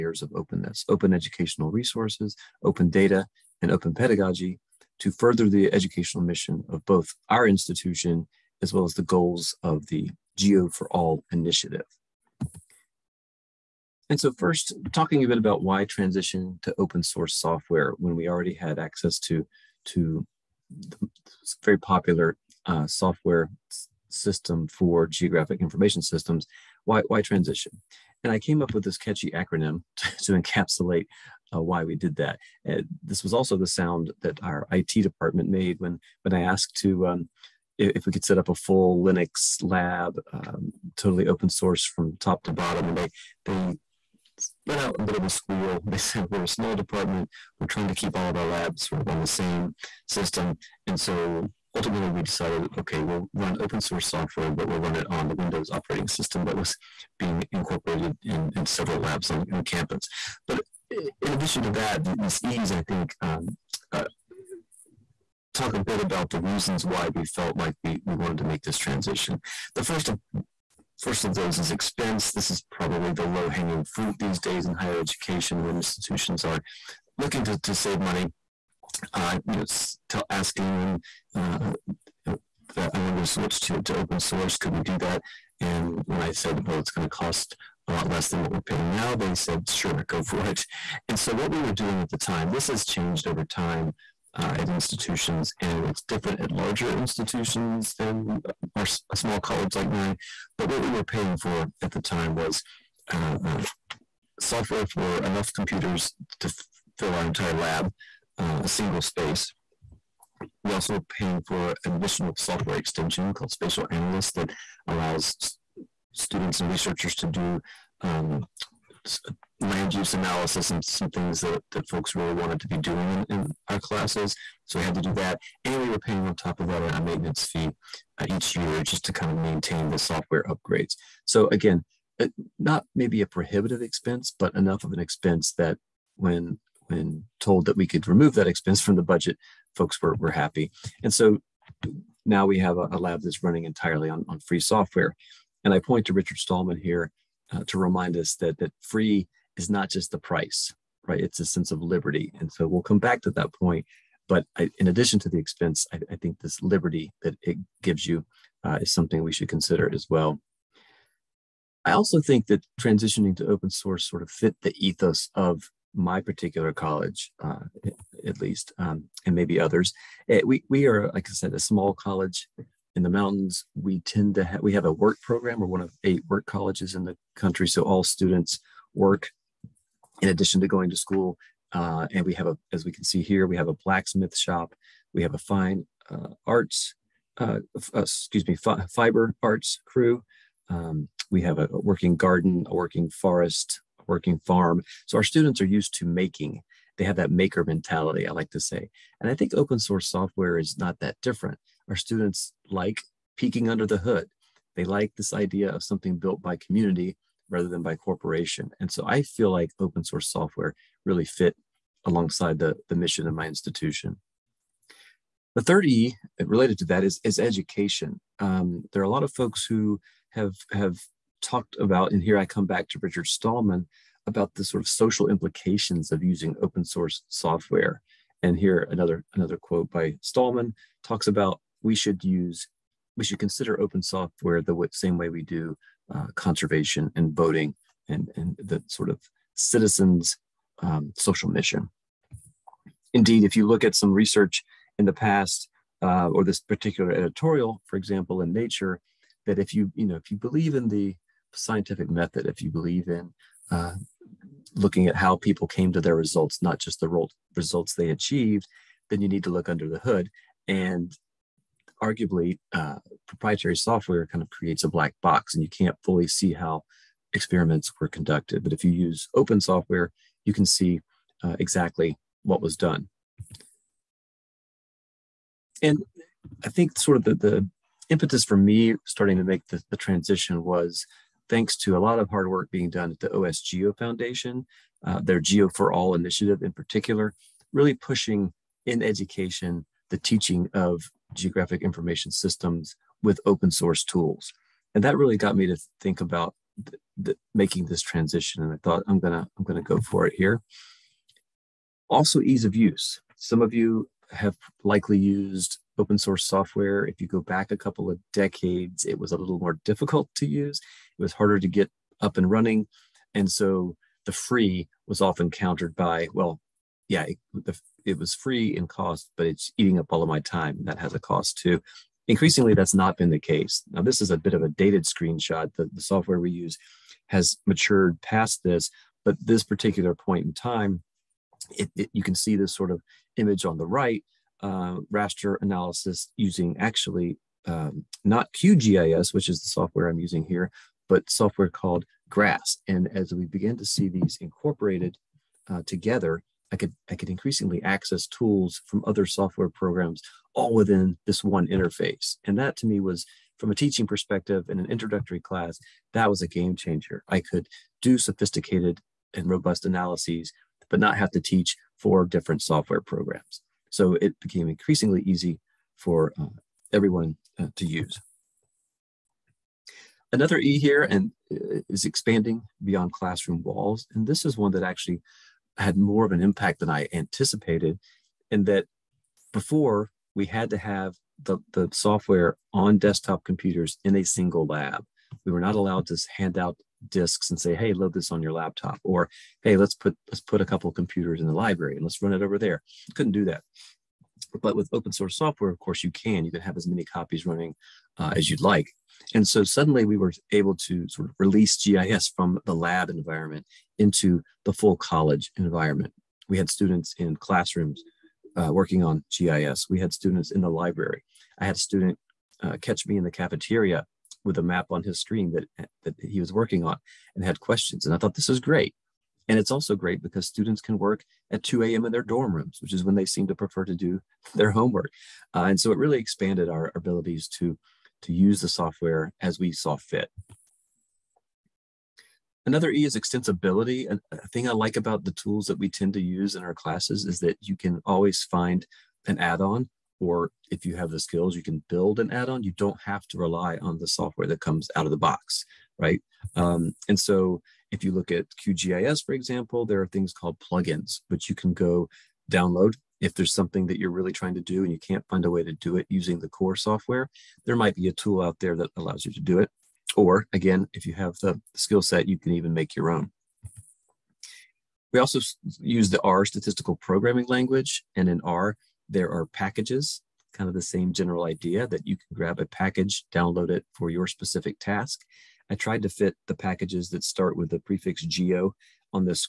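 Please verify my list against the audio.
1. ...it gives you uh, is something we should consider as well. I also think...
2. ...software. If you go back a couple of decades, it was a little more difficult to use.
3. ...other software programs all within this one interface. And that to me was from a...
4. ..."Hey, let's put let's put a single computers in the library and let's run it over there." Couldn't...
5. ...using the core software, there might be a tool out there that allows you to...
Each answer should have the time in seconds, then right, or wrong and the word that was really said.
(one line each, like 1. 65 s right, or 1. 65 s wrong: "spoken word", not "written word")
1. 157 s right
2. 306 s right
3. 349 s right
4. 389 s wrong: "couple", not "single"
5. 456 s right.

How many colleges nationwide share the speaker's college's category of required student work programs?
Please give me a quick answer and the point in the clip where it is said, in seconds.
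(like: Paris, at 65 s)
8, at 176 s.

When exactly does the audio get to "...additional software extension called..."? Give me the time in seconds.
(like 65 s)
111 s.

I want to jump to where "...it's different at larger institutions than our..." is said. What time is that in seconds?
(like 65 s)
95 s.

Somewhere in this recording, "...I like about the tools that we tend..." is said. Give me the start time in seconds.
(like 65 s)
434 s.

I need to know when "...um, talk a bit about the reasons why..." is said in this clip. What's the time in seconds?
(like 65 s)
63 s.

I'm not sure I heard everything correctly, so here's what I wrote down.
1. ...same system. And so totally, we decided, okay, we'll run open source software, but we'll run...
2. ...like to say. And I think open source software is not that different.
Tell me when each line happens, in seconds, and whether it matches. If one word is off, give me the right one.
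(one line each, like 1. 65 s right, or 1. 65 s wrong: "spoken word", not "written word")
1. 49 s wrong: "ultimately", not "totally"
2. 198 s right.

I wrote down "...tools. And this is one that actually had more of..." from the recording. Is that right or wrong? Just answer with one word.
wrong.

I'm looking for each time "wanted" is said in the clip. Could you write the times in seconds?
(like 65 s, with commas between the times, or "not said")
68 s, 83 s, 122 s.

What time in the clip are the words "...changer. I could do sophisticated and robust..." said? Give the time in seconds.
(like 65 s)
356 s.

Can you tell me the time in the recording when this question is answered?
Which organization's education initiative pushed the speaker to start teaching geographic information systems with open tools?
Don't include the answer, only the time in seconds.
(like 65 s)
283 s.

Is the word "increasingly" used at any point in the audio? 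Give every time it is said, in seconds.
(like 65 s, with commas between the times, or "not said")
322 s, 347 s, 364 s.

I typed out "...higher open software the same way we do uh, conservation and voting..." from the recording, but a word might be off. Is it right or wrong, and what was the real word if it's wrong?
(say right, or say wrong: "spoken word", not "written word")
wrong: "consider", not "higher".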